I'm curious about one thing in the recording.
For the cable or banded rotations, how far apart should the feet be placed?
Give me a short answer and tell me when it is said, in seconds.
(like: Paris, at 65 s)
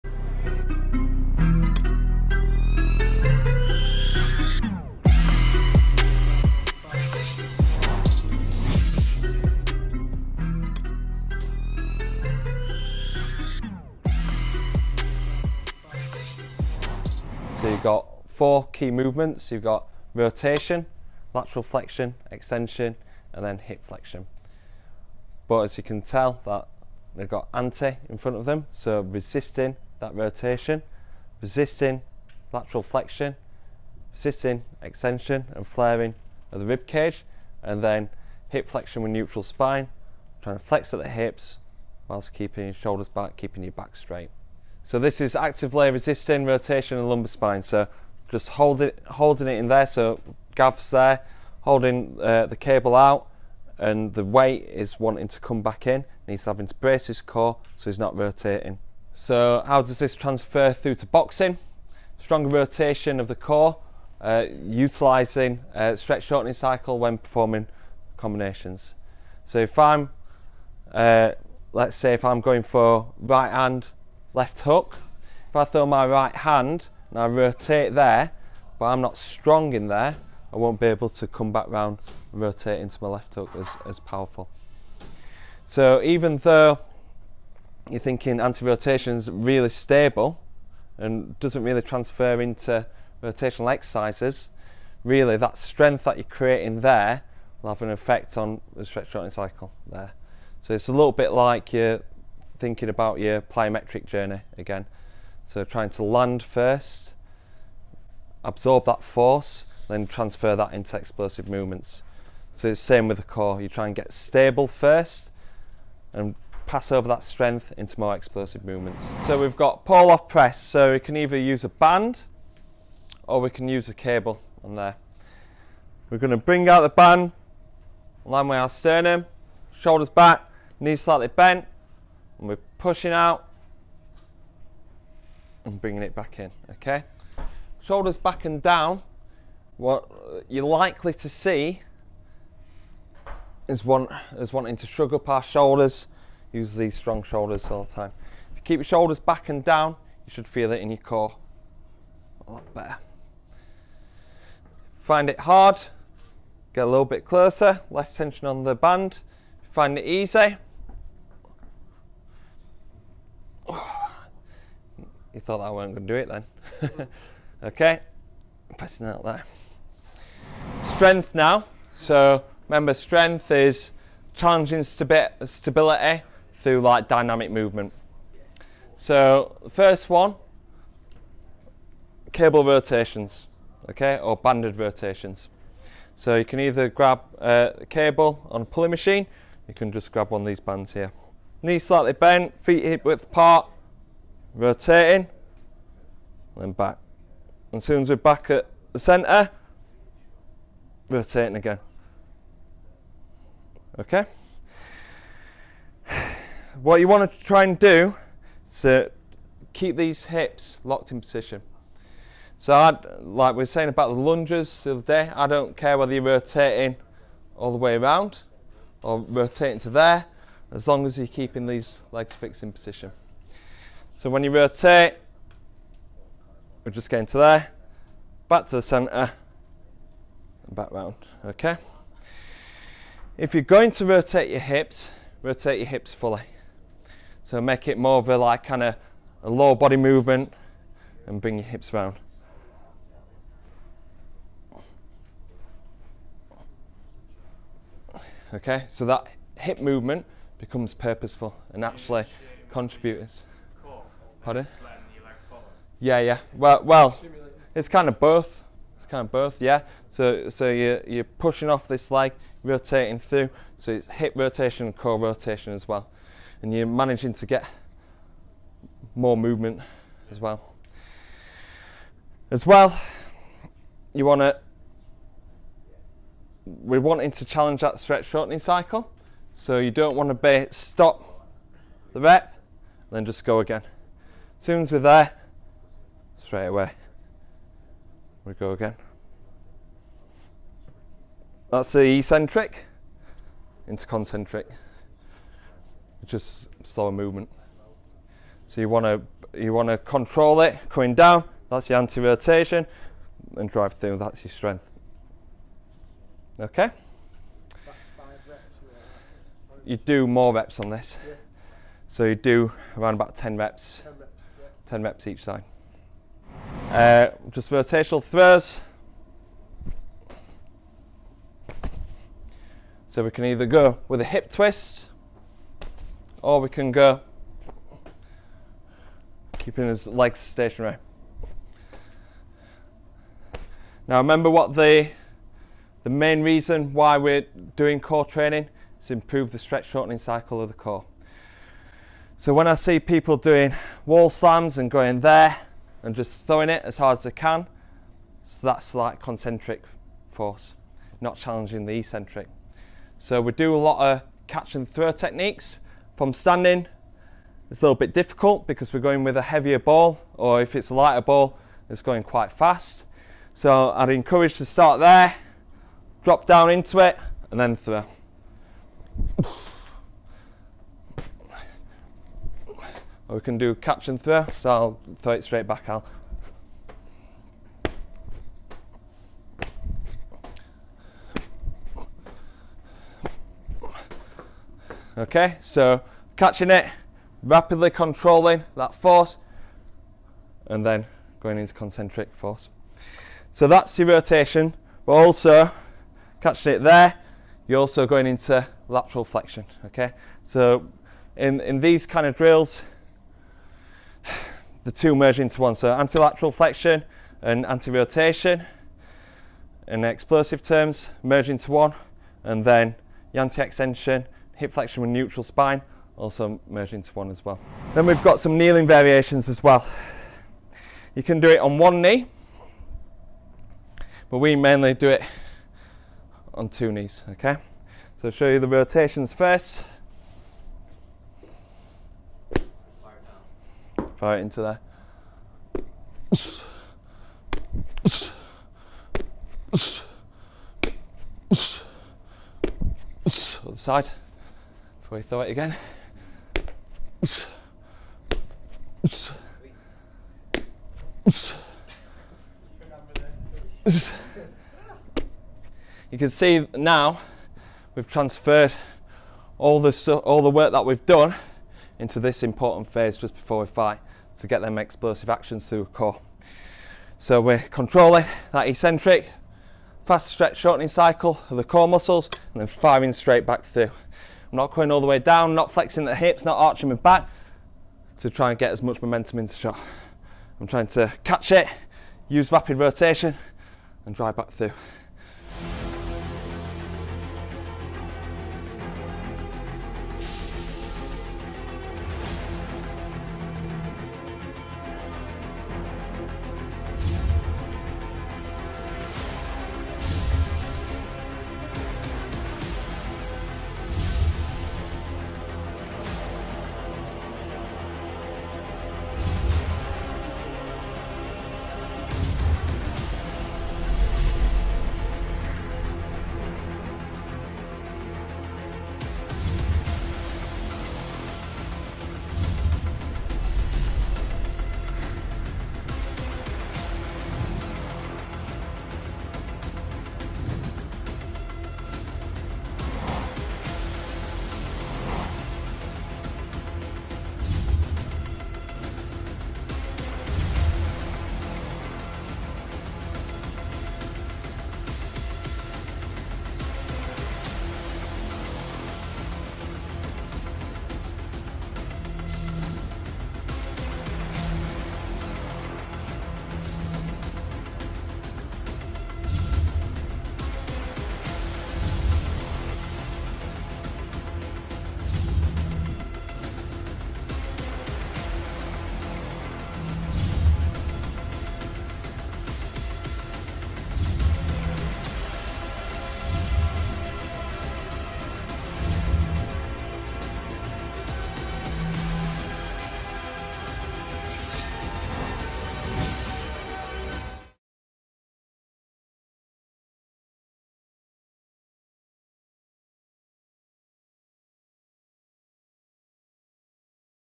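hip width, at 192 s.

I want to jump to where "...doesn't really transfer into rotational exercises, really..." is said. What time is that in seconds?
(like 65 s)
91 s.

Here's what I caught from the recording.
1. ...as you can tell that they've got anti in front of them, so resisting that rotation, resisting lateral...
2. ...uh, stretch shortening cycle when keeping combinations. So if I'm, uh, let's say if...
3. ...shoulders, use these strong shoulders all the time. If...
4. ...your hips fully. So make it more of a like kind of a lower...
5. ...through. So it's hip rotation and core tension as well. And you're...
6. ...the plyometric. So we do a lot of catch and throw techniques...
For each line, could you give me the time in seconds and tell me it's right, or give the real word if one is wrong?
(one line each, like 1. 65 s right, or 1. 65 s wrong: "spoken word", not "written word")
1. 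25 s right
2. 65 s wrong: "performing", not "keeping"
3. 145 s right
4. 235 s right
5. 263 s wrong: "rotation", not "tension"
6. 351 s wrong: "eccentric", not "plyometric".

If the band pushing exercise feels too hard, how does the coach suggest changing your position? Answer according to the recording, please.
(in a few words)
get a little bit closer.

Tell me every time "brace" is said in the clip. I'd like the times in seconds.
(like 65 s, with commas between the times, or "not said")
56 s.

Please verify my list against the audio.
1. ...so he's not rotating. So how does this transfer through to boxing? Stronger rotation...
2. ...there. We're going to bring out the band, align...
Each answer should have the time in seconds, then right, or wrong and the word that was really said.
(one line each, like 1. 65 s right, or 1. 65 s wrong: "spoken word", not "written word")
1. 57 s right
2. 124 s right.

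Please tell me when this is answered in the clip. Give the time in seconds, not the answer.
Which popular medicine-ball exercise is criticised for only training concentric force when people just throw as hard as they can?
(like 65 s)
344 s.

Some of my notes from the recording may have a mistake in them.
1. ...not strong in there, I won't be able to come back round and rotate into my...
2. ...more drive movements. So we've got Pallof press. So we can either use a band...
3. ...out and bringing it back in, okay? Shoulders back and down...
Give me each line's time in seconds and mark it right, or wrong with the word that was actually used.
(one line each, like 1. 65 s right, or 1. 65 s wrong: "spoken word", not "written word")
1. 79 s right
2. 117 s wrong: "explosive", not "drive"
3. 133 s right.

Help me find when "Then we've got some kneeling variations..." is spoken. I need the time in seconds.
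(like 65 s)
417 s.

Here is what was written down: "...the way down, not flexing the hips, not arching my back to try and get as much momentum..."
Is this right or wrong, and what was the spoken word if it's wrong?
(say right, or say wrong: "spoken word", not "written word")
right.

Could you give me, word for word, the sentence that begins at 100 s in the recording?
So it's a little bit like you're thinking about your plyometric journey again.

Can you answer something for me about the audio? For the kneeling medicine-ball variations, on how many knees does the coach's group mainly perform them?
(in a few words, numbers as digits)
2.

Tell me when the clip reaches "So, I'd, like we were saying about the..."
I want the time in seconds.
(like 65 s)
212 s.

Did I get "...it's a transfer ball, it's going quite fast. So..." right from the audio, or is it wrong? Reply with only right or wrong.
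wrong.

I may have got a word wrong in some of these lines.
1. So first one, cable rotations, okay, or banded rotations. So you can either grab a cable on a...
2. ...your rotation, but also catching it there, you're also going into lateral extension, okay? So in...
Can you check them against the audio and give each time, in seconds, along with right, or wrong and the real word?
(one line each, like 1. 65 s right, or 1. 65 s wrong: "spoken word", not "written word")
1. 178 s right
2. 393 s wrong: "flexion", not "extension".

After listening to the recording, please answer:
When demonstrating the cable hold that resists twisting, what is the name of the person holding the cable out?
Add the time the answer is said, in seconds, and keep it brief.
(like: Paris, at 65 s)
Gav, at 50 s.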